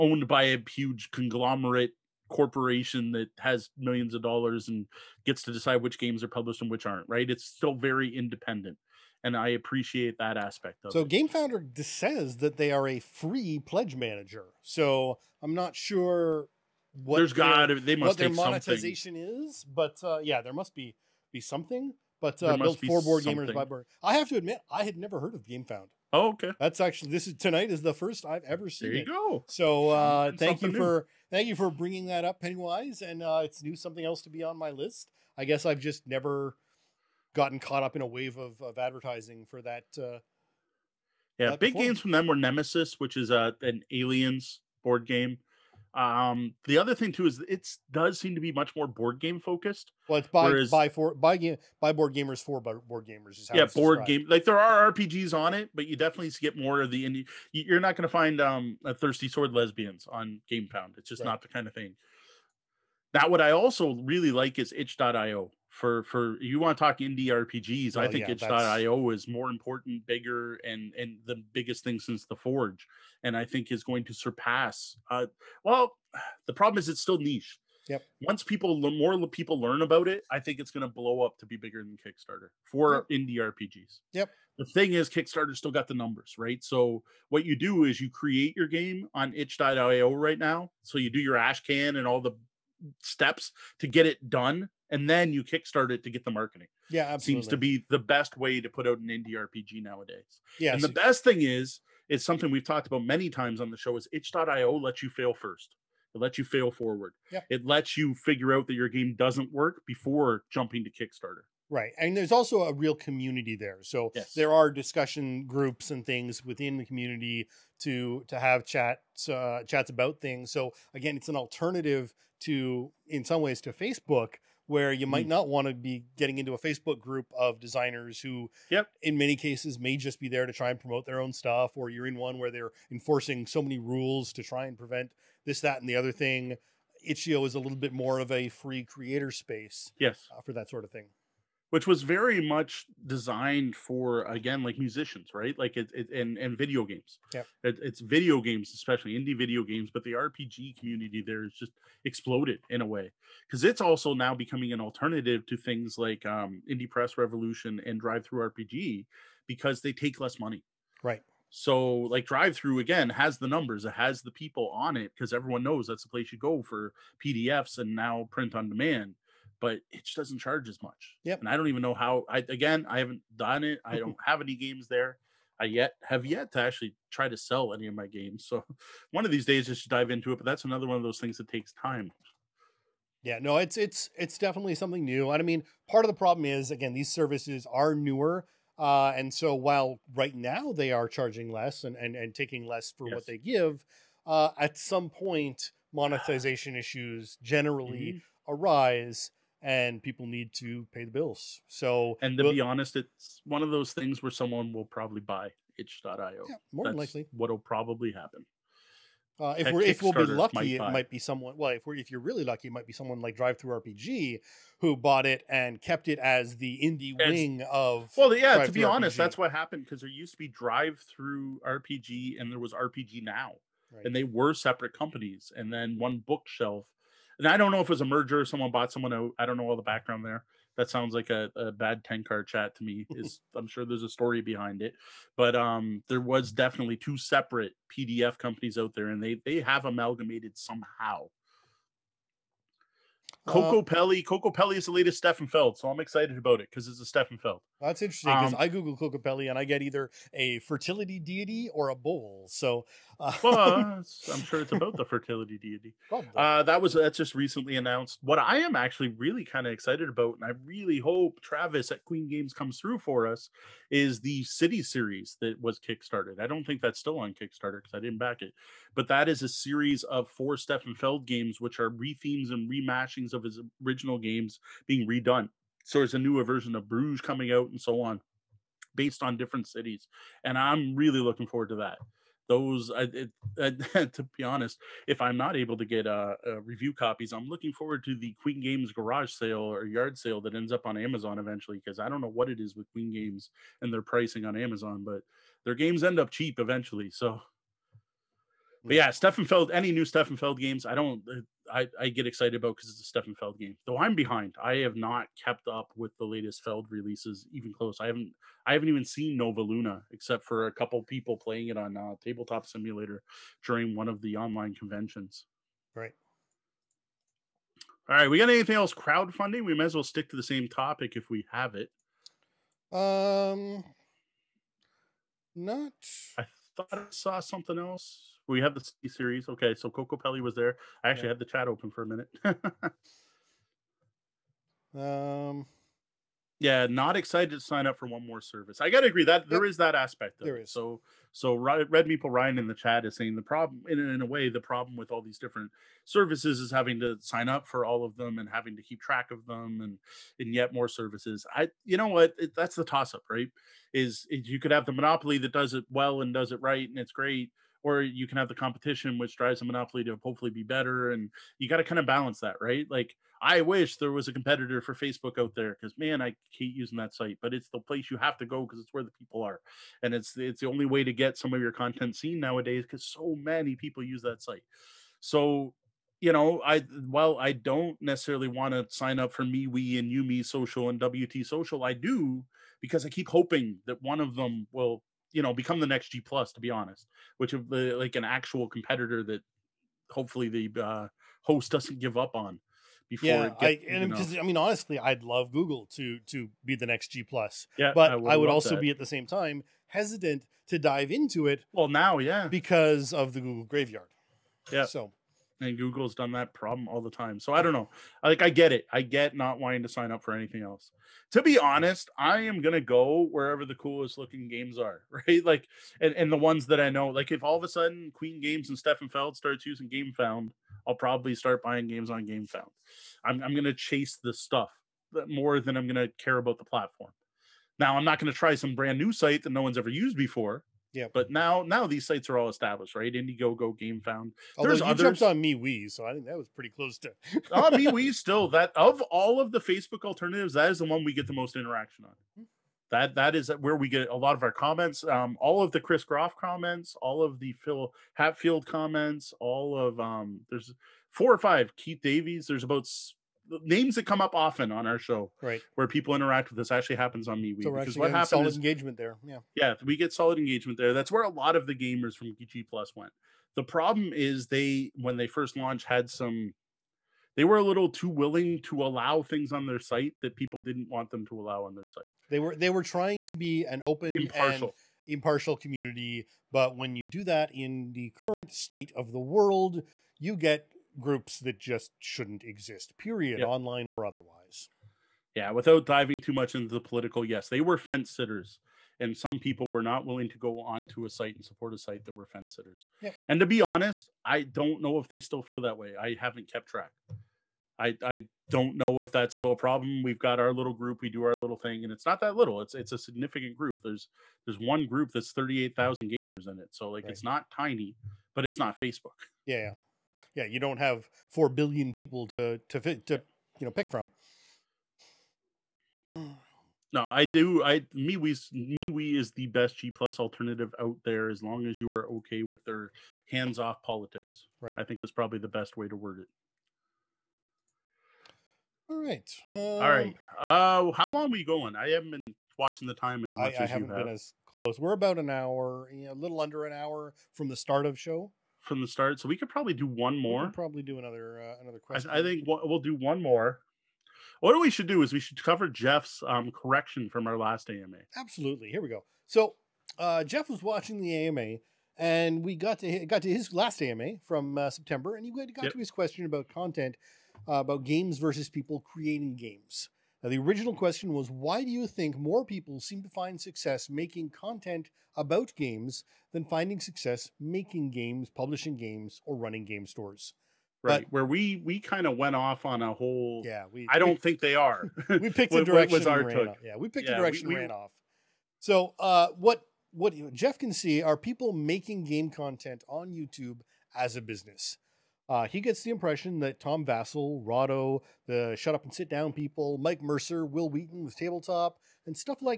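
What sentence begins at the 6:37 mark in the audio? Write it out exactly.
Yeah, but I would, I would also that.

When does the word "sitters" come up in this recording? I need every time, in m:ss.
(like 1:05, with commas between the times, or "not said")
8:08, 8:12.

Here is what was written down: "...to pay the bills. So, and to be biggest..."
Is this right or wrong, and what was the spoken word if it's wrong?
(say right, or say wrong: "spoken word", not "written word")
wrong: "honest", not "biggest".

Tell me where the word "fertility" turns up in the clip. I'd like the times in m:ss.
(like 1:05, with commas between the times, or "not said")
4:10, 4:15.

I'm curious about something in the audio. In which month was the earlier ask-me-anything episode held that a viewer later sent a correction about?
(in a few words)
September.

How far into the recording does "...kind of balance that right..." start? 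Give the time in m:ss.
6:01.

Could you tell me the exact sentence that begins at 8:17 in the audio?
I, I don't know if that's still a problem.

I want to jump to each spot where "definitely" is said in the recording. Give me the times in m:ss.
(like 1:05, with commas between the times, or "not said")
0:55, 3:04, 3:56.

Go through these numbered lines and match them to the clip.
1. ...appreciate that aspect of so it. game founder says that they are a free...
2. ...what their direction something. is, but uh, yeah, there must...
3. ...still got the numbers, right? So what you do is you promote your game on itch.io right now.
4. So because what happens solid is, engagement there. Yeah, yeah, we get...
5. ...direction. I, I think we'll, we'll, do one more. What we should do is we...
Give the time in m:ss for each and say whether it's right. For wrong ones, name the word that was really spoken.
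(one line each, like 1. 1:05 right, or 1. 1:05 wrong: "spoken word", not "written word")
1. 0:09 right
2. 0:18 wrong: "monetization", not "direction"
3. 1:25 wrong: "create", not "promote"
4. 7:37 right
5. 9:01 wrong: "question", not "direction".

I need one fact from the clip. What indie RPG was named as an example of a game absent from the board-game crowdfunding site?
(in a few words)
Thirsty Sword Lesbians.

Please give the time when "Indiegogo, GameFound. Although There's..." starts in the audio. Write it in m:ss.
7:13.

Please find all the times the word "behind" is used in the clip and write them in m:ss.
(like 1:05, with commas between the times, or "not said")
3:54, 5:04.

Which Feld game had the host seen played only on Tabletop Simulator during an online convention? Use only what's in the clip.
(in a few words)
Nova Luna.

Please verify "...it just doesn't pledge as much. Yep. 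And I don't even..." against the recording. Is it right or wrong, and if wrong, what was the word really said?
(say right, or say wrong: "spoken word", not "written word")
wrong: "charge", not "pledge".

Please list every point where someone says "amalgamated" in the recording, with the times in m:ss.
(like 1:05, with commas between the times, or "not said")
3:59.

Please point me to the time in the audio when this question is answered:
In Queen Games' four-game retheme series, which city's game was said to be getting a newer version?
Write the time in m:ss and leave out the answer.
4:36.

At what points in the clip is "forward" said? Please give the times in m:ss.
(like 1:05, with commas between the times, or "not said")
1:46, 4:41, 4:47.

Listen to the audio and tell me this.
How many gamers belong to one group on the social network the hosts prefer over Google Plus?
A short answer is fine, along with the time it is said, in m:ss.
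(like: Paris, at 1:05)
38,000, at 8:25.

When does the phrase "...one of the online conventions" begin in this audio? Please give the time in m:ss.
5:13.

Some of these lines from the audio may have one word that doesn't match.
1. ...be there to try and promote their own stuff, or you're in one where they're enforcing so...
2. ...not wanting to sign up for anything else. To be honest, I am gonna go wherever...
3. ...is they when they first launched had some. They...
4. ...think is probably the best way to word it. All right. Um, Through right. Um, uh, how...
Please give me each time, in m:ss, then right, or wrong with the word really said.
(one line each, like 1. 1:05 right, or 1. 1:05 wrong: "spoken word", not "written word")
1. 2:10 right
2. 6:49 right
3. 7:44 right
4. 8:44 wrong: "All", not "Through".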